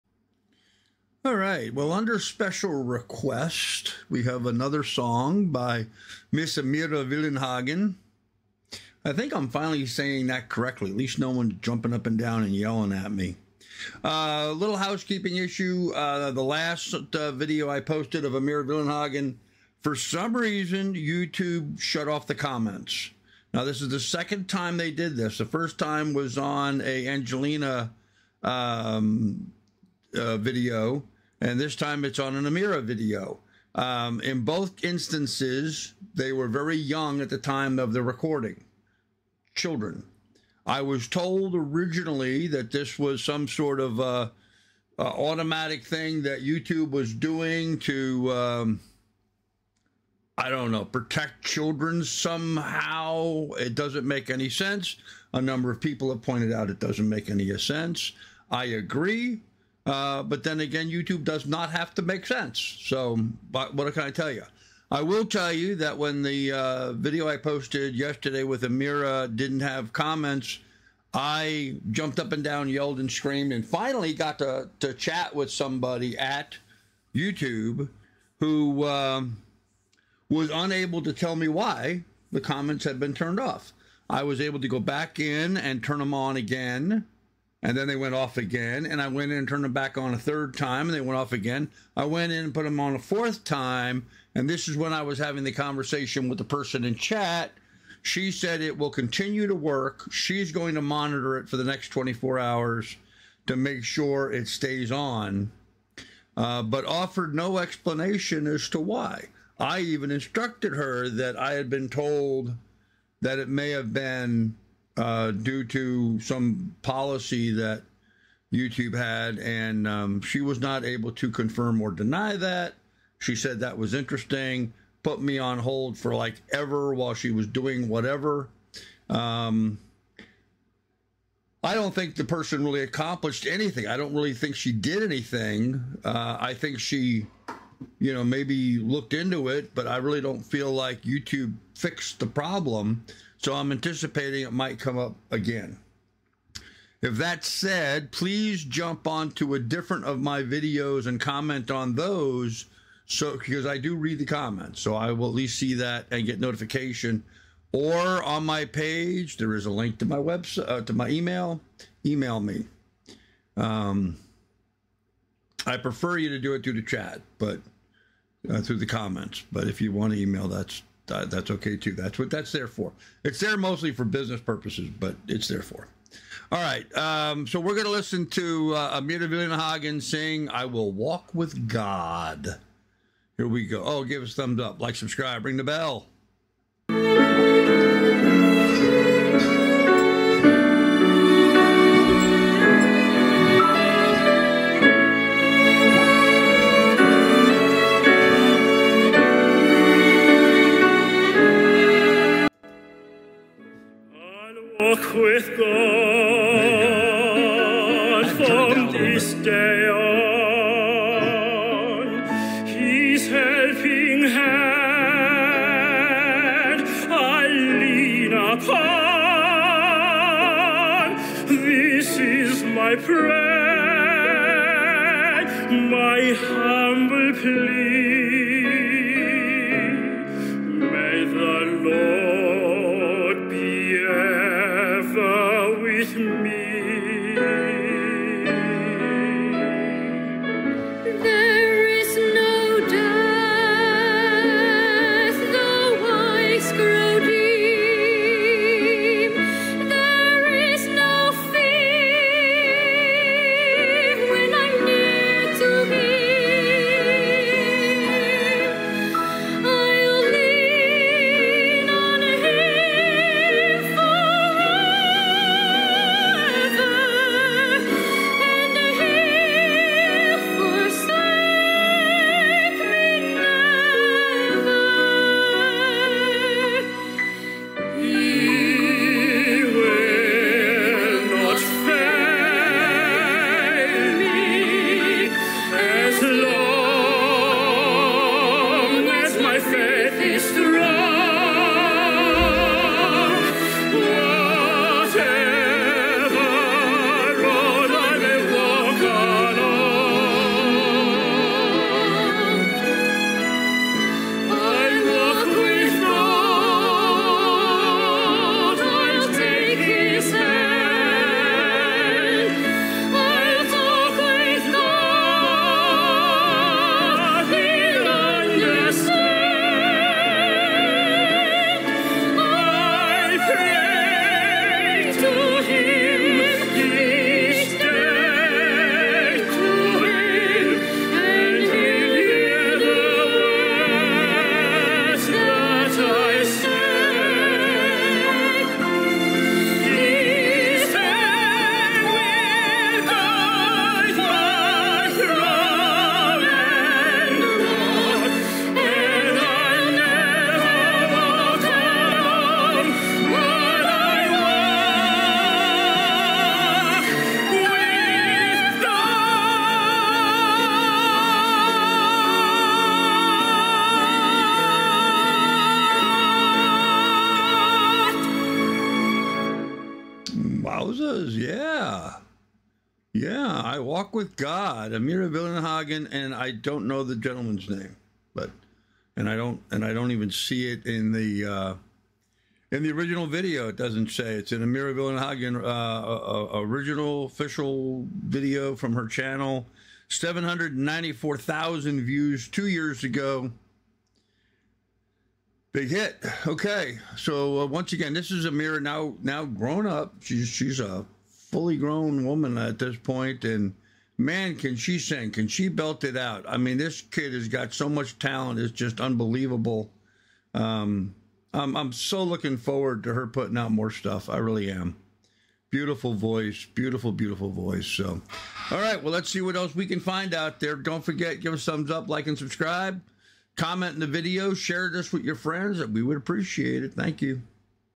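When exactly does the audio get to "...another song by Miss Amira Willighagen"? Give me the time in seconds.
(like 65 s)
4 s.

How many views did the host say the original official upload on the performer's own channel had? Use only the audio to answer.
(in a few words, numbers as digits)
794,000.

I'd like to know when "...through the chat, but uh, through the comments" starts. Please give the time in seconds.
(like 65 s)
166 s.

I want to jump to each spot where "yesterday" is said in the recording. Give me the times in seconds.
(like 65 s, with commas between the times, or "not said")
67 s.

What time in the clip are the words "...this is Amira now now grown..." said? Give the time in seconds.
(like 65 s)
398 s.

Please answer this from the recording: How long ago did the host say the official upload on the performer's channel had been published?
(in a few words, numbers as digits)
two years ago.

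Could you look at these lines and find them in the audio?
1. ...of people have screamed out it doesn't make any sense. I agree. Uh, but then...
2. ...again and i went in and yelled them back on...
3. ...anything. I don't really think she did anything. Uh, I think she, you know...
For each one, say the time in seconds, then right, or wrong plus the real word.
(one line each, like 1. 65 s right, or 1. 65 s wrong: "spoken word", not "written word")
1. 55 s wrong: "pointed", not "screamed"
2. 88 s wrong: "turned", not "yelled"
3. 133 s right.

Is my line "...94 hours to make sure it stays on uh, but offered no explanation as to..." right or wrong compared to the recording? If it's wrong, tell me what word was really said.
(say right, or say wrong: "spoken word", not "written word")
wrong: "24", not "94".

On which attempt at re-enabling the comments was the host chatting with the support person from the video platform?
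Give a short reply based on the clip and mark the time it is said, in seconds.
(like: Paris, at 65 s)
fourth, at 92 s.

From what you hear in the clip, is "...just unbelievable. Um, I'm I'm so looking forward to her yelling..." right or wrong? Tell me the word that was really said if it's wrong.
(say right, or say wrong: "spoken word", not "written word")
wrong: "putting", not "yelling".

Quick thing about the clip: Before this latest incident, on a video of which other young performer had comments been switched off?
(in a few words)
Angelina.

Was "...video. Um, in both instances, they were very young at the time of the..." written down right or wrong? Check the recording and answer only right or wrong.
right.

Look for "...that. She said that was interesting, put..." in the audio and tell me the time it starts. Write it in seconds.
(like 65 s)
122 s.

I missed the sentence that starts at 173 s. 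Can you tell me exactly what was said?
It's there mostly for business purposes, but it's there for.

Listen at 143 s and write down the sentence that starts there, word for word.
So I'm anticipating it might come up again.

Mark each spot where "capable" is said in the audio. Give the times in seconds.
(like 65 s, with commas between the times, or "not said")
not said.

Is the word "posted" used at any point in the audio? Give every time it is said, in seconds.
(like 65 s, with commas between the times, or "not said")
17 s, 67 s.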